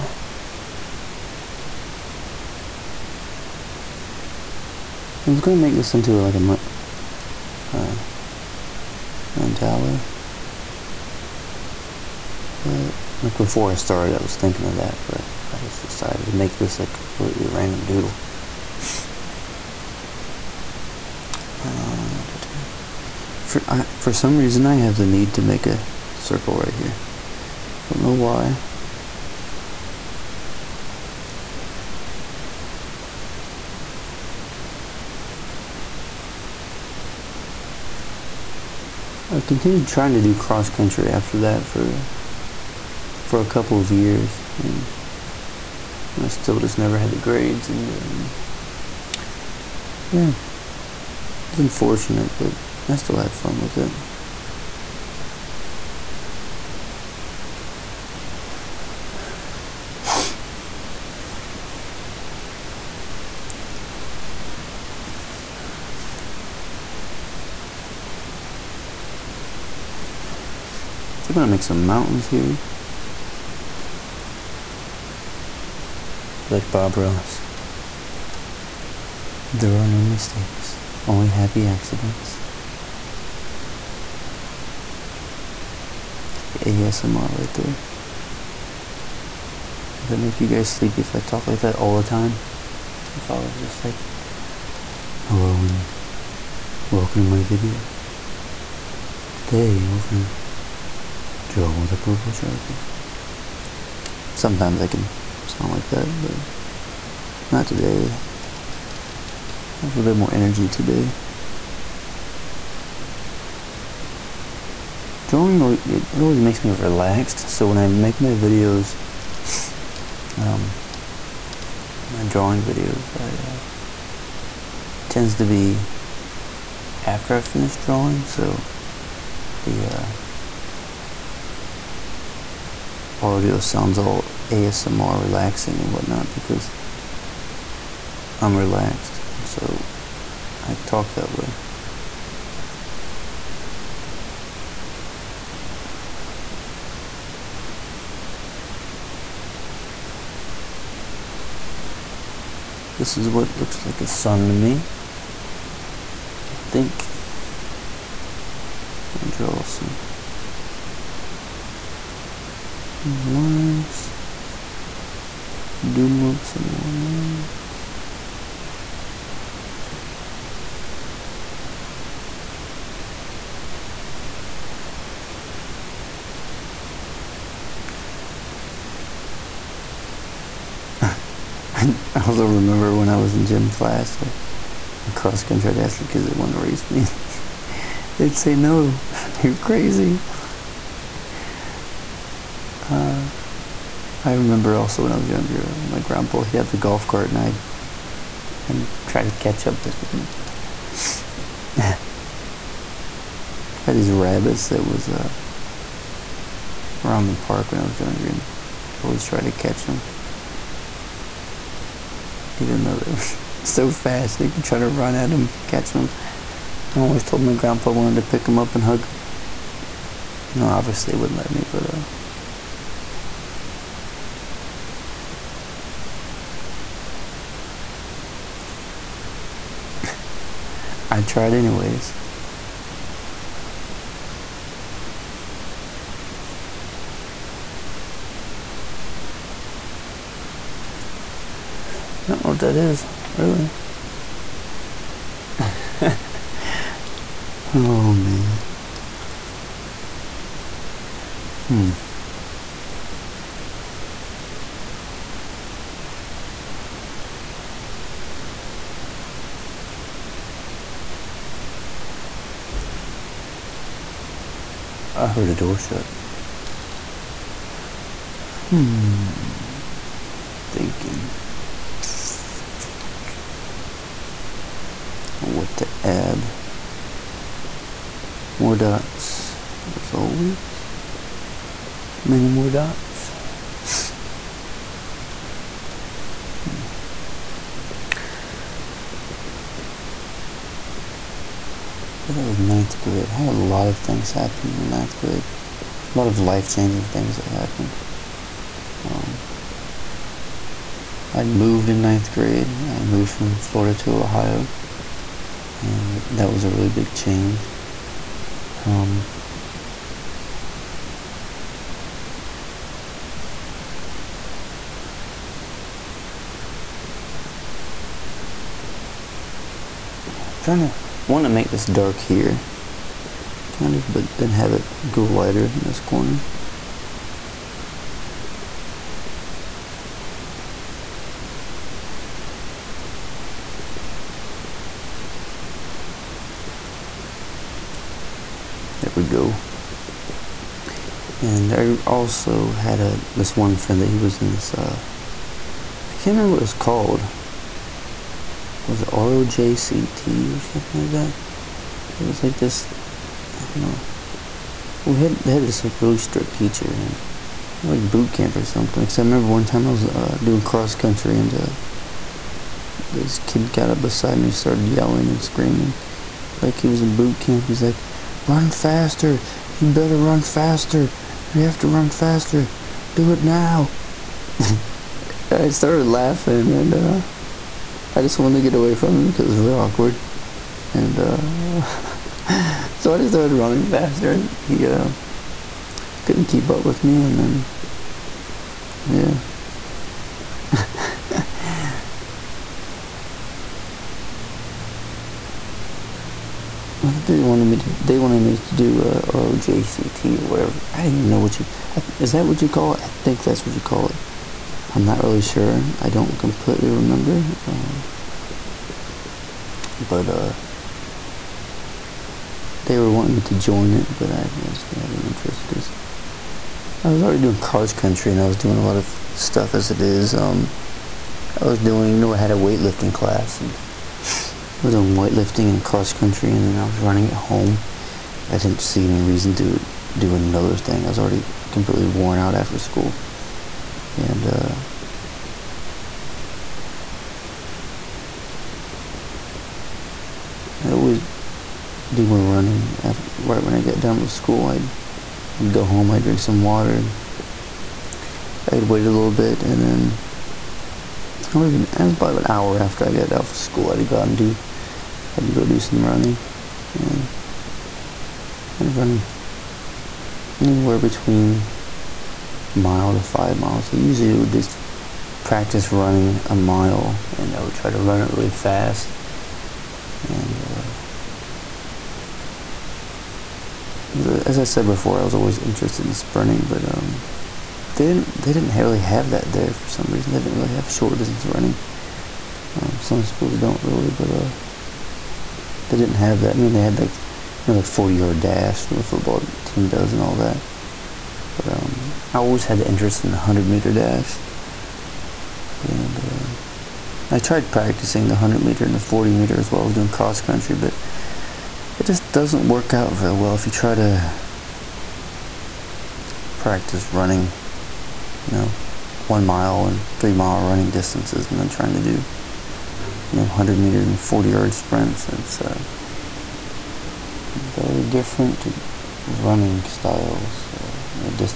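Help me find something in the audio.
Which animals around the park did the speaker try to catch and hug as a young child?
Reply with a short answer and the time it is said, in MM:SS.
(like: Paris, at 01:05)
rabbits, at 03:24.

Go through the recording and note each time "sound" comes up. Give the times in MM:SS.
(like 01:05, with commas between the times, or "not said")
01:45, 02:13.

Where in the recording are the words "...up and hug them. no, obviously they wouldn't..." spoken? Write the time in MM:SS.
03:38.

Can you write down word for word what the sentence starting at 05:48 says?
Was it ROJCT or something like that?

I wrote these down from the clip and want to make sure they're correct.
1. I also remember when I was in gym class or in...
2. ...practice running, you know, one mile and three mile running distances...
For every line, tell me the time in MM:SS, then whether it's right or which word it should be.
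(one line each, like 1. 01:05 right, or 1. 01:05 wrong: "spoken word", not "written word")
1. 03:02 right
2. 08:26 right.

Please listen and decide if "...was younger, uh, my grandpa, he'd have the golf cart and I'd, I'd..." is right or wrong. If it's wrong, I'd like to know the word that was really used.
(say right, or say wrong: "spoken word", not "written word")
right.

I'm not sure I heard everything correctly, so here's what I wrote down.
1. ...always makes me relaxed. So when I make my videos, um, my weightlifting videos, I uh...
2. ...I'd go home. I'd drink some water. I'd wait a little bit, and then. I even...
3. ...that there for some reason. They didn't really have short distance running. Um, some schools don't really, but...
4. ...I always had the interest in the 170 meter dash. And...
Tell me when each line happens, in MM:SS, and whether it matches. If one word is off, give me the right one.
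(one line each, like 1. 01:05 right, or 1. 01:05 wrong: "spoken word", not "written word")
1. 01:56 wrong: "drawing", not "weightlifting"
2. 07:25 right
3. 07:59 right
4. 08:12 wrong: "100", not "170".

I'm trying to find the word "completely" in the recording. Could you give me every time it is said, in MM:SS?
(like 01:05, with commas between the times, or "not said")
00:16, 06:46, 07:11.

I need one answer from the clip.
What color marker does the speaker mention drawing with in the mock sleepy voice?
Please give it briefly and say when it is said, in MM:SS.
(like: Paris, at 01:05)
purple, at 01:41.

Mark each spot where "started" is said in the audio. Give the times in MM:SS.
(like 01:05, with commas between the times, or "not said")
00:13, 06:04, 06:15, 06:23.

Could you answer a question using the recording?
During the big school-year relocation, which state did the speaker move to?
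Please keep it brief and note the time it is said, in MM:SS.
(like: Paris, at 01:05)
Ohio, at 05:04.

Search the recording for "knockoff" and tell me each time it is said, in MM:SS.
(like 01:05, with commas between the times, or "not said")
not said.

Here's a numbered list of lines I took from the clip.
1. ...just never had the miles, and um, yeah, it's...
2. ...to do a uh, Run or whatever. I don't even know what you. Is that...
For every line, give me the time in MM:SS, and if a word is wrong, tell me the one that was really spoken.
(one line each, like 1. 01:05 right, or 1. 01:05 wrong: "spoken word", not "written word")
1. 00:46 wrong: "grades", not "miles"
2. 06:38 wrong: "ROJCT", not "Run".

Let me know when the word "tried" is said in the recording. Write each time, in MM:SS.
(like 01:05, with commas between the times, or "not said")
03:29, 03:51, 08:17.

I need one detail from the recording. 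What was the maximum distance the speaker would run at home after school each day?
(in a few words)
5 miles.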